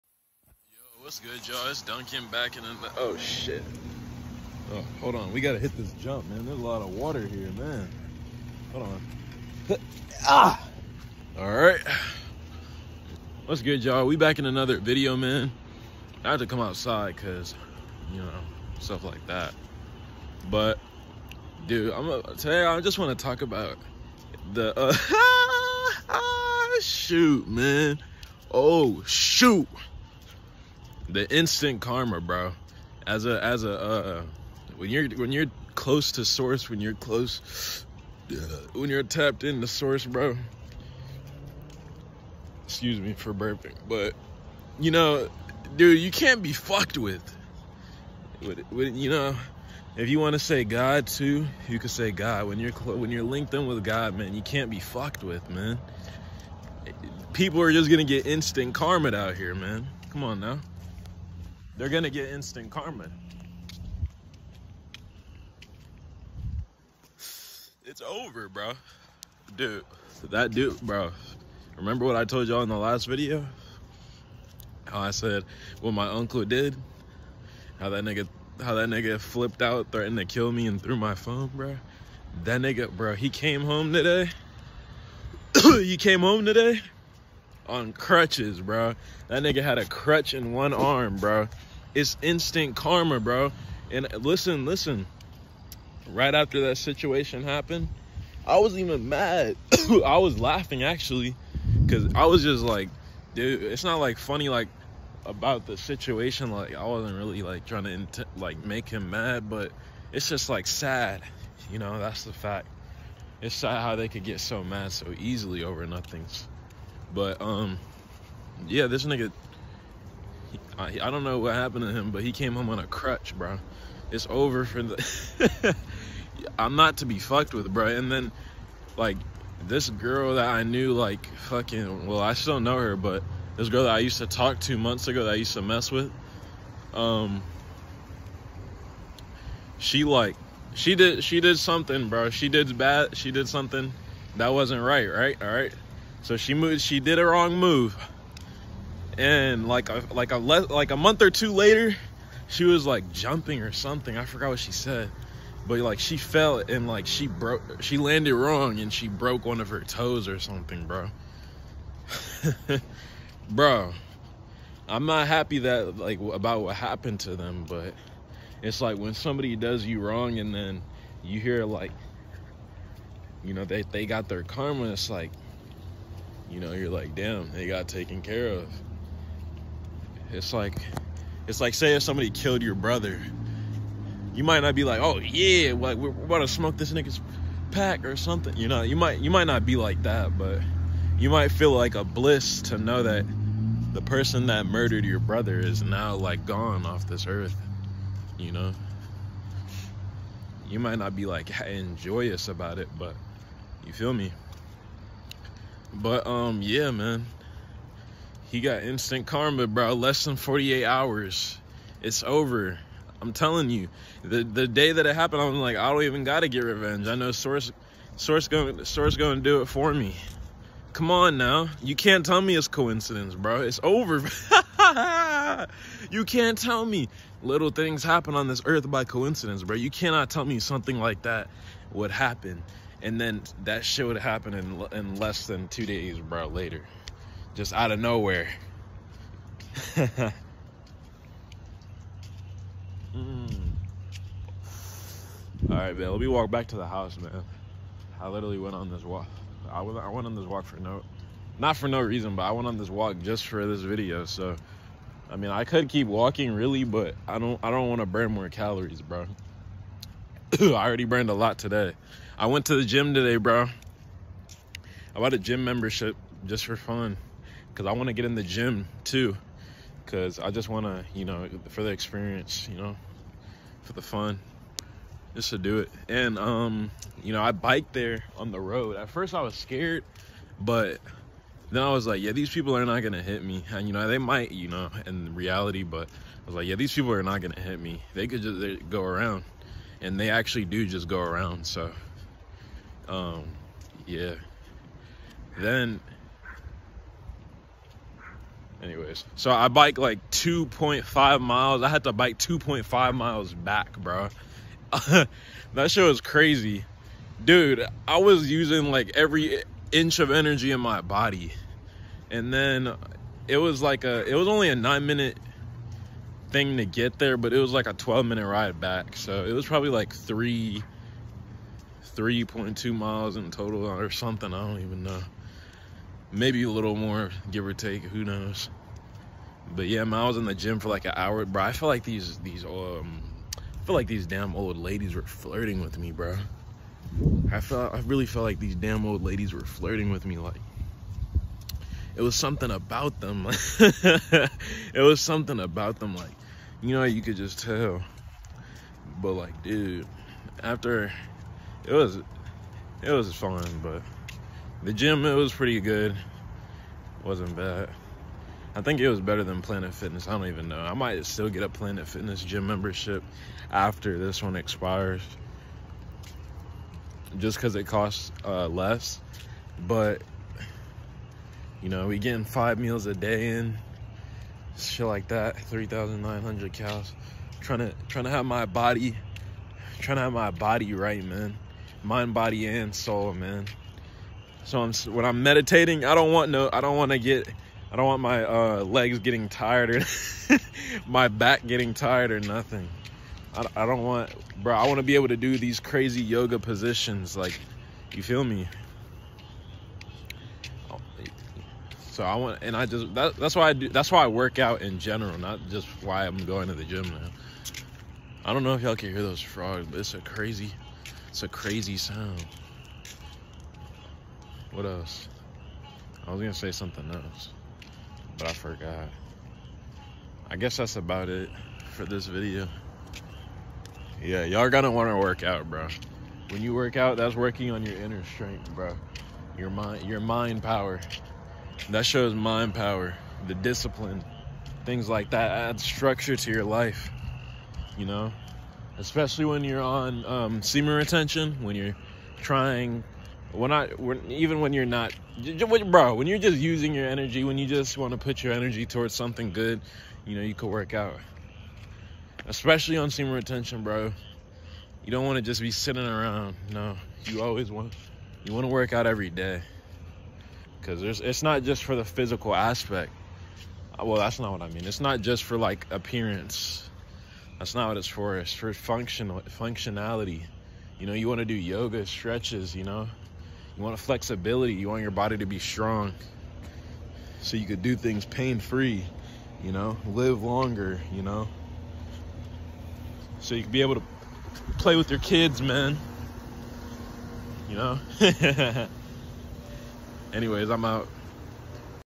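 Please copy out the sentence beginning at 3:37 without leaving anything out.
I know Source Source going Source gonna do it for me.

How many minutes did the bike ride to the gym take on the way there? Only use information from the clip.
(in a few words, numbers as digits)
9 minutes.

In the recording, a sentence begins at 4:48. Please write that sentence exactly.
They could just they go around and they actually do just go around.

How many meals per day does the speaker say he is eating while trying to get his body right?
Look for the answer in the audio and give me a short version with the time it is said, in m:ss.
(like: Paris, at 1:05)
5, at 6:12.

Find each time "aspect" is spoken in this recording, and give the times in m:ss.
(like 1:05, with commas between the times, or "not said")
7:42.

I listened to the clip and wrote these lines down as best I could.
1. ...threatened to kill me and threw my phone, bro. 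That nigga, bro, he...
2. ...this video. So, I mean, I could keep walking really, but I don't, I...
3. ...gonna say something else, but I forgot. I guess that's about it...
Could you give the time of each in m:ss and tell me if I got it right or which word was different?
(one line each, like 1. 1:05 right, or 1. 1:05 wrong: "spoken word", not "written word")
1. 1:19 right
2. 4:13 right
3. 6:56 right.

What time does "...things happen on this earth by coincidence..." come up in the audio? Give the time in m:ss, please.
3:47.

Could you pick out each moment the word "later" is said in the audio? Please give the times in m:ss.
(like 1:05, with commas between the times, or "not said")
2:31, 3:56.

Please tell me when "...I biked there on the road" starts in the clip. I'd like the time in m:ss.
4:37.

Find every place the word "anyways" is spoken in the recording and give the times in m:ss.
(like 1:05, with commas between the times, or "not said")
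4:58, 8:10.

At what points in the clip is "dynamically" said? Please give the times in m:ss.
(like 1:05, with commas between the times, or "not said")
not said.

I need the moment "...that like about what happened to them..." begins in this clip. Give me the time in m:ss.
2:45.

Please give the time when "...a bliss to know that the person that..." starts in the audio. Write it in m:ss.
3:11.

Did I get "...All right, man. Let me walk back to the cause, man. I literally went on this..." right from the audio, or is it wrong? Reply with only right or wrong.
wrong.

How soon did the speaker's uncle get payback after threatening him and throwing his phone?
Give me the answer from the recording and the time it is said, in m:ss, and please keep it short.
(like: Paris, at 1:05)
Less than 48 hours, at 3:29.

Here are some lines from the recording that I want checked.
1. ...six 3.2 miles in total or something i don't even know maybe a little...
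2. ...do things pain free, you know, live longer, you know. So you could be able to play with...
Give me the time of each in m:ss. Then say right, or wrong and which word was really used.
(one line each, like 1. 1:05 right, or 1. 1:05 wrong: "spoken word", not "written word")
1. 5:20 wrong: "three", not "six"
2. 7:57 right.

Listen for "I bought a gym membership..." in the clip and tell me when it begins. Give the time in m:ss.
4:25.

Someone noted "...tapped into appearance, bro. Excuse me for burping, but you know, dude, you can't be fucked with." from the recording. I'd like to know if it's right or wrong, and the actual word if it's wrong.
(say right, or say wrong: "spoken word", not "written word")
wrong: "source", not "appearance".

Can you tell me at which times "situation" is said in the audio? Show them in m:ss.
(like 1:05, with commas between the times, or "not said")
1:36, 1:45.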